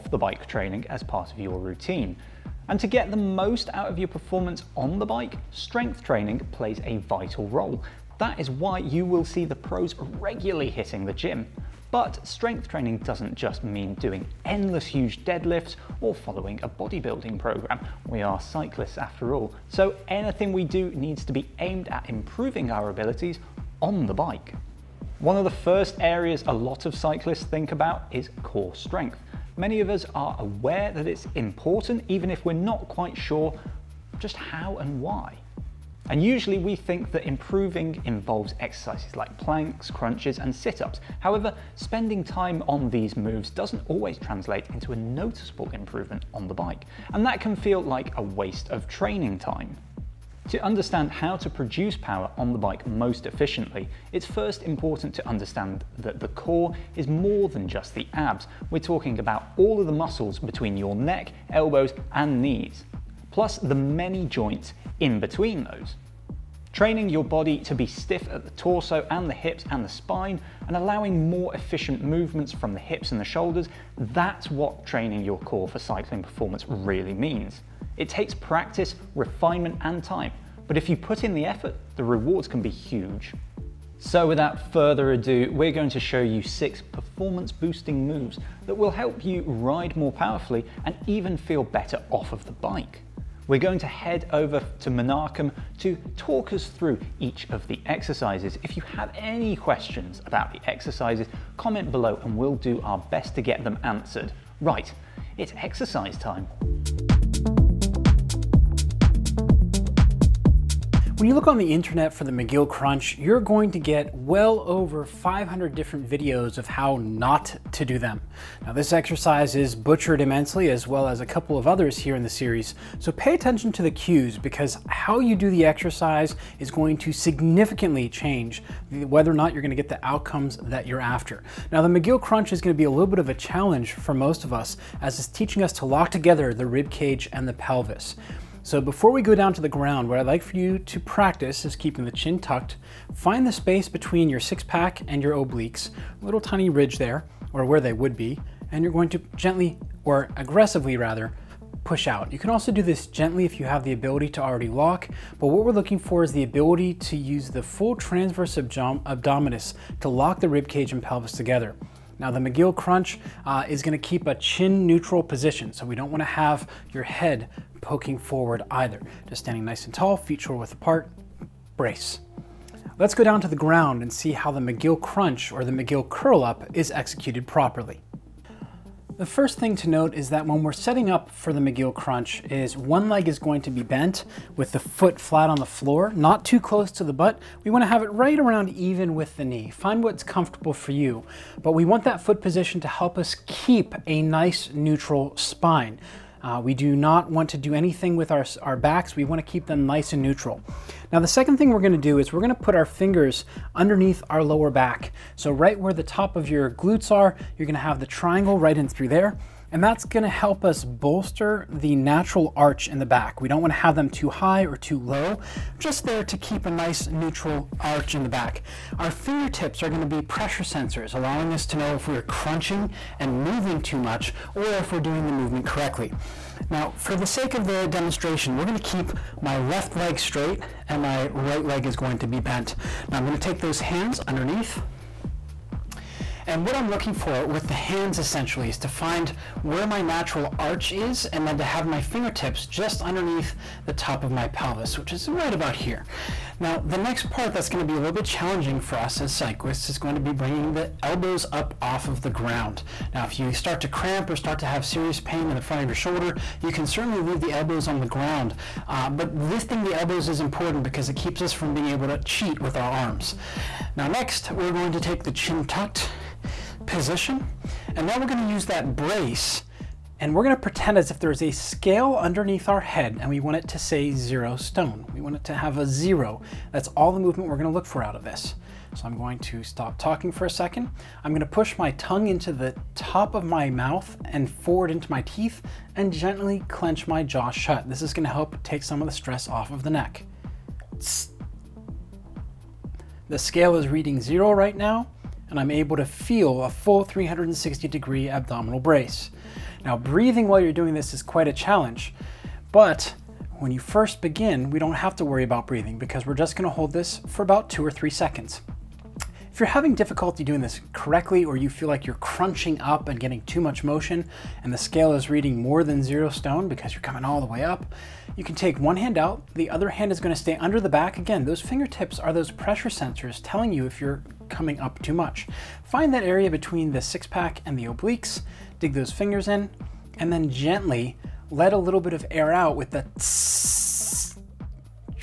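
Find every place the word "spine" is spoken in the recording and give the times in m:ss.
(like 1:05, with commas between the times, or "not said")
1:09, 3:15.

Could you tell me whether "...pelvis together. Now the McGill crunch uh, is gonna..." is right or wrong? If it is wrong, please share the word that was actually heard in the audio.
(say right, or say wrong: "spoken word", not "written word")
right.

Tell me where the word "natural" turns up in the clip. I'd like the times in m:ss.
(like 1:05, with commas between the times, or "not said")
3:31, 4:00.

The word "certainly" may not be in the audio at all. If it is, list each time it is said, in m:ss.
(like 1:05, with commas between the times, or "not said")
4:16.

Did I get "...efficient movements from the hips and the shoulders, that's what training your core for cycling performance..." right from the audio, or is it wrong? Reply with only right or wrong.
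right.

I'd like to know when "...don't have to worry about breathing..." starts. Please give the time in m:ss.
5:04.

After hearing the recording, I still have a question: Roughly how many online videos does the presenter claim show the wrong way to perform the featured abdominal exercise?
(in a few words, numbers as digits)
over 500.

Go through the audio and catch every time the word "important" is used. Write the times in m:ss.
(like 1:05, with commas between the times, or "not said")
0:31, 0:54, 4:20.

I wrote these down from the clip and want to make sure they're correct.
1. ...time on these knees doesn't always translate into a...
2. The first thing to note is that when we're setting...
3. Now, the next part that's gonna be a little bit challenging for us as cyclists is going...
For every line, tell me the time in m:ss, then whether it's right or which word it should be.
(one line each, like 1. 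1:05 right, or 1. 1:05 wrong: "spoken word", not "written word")
1. 0:42 wrong: "moves", not "knees"
2. 2:59 right
3. 4:06 right.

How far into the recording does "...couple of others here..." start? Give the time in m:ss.
2:01.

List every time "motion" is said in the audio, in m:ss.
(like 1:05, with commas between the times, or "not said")
5:13.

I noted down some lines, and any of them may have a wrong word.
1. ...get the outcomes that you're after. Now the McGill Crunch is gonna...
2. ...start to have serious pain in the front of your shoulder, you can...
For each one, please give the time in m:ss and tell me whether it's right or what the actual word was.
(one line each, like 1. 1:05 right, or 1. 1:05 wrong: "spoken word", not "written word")
1. 2:09 right
2. 4:14 right.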